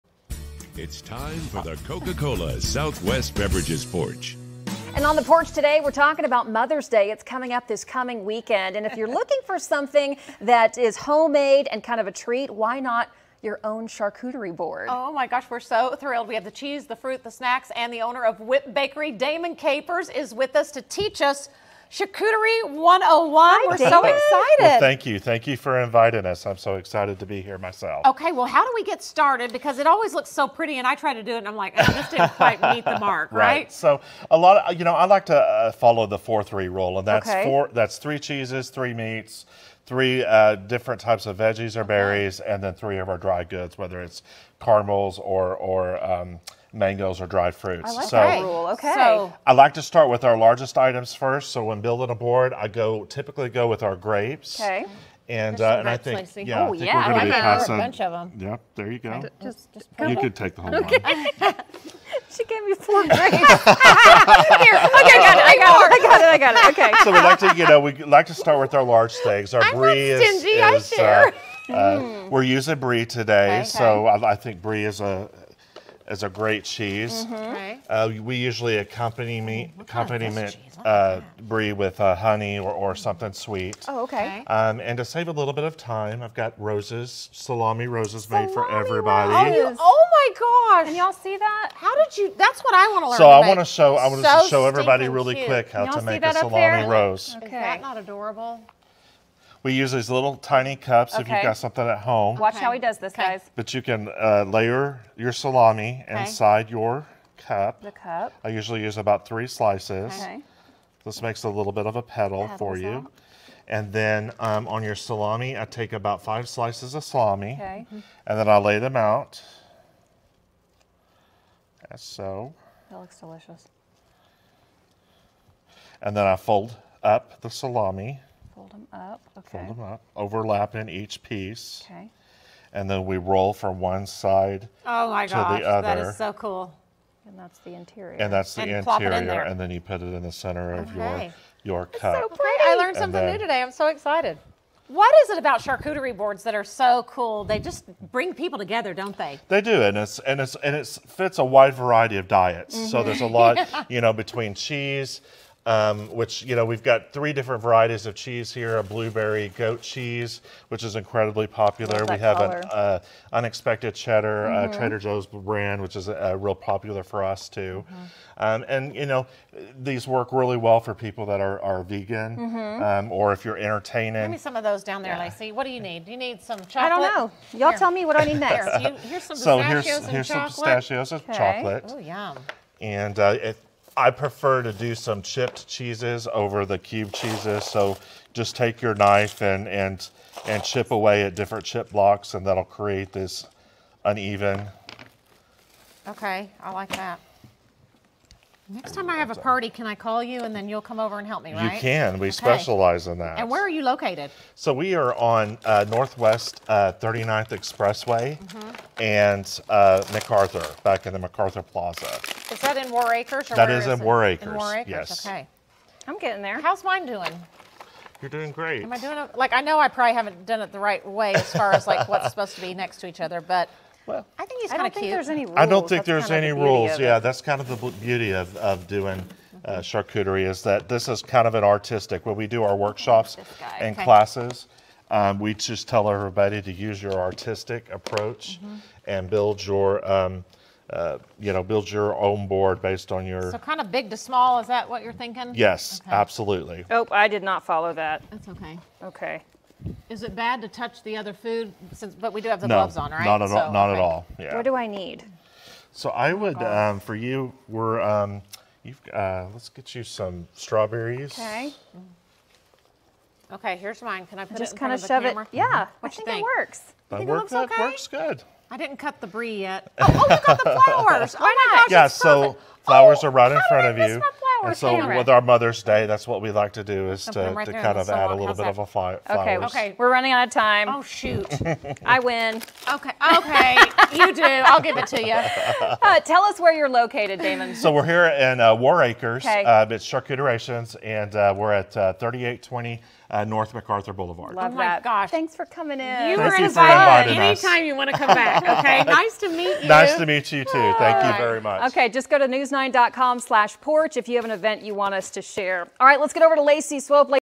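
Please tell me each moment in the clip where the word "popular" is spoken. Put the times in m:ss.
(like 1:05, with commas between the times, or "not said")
2:41, 2:46.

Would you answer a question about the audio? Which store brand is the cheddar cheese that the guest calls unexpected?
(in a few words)
Trader Joe's.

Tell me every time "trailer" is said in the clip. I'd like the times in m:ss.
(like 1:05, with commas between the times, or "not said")
not said.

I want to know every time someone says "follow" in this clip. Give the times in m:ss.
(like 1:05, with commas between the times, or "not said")
0:35, 4:07.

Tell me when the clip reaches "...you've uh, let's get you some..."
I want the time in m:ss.
4:18.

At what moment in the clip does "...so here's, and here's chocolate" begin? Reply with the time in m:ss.
2:59.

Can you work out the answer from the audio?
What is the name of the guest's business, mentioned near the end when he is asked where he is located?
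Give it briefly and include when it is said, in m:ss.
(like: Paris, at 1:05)
Charcuterations, at 4:50.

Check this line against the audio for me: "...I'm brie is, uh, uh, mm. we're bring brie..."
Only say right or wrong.
wrong.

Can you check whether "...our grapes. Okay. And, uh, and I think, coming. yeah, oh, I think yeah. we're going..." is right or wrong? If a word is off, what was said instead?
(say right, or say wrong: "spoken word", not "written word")
wrong: "slicing", not "coming".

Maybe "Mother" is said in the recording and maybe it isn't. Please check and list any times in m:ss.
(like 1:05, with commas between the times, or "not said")
0:06, 4:35.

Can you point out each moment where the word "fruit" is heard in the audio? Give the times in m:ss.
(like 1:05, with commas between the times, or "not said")
0:16, 0:47.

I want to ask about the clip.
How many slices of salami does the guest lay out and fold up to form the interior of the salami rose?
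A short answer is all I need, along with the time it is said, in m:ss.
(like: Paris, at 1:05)
5, at 1:55.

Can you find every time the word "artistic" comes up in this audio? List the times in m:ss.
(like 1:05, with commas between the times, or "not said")
3:51, 3:57.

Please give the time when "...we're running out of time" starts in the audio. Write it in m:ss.
4:39.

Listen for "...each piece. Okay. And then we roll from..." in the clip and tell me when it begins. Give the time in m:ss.
2:10.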